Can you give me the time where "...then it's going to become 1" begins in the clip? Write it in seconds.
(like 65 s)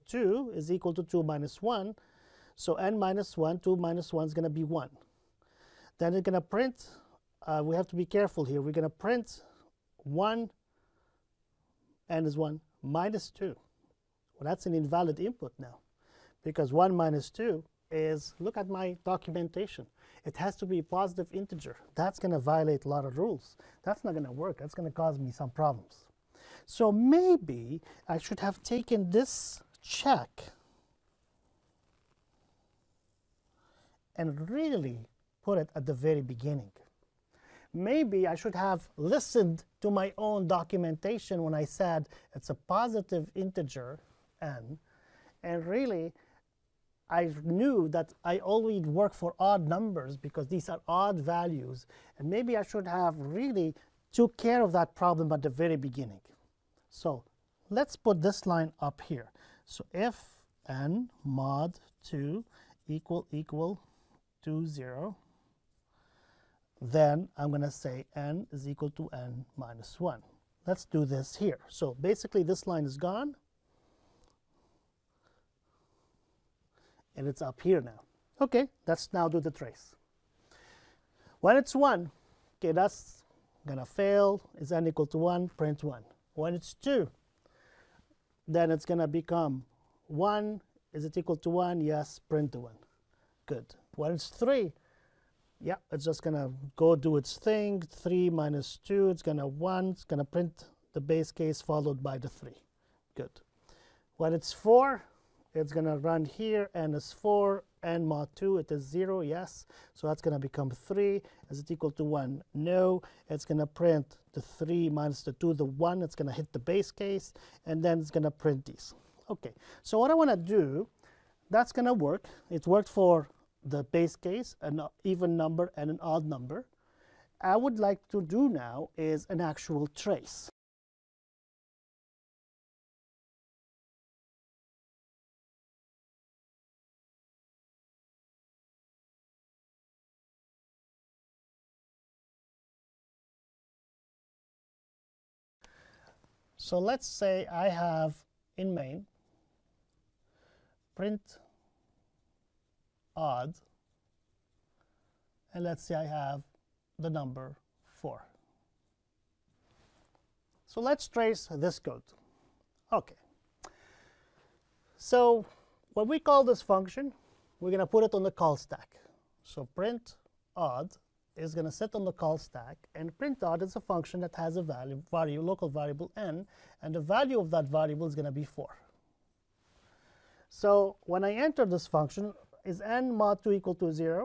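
88 s.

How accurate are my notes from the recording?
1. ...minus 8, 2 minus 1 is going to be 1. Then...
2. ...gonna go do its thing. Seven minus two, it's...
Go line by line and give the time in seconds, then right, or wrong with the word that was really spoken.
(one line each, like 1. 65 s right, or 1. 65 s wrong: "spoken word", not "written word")
1. 2 s wrong: "1", not "8"
2. 96 s wrong: "Three", not "Seven".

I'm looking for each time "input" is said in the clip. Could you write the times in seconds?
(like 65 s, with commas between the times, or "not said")
15 s.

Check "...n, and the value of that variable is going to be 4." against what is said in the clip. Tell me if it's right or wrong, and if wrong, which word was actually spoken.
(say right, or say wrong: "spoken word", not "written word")
right.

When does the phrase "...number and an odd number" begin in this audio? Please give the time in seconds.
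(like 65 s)
125 s.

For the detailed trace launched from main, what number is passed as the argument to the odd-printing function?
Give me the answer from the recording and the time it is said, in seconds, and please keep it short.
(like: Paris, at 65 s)
4, at 156 s.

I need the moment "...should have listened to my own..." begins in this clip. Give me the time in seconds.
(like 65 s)
38 s.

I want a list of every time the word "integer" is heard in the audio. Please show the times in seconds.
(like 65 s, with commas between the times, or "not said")
21 s, 43 s.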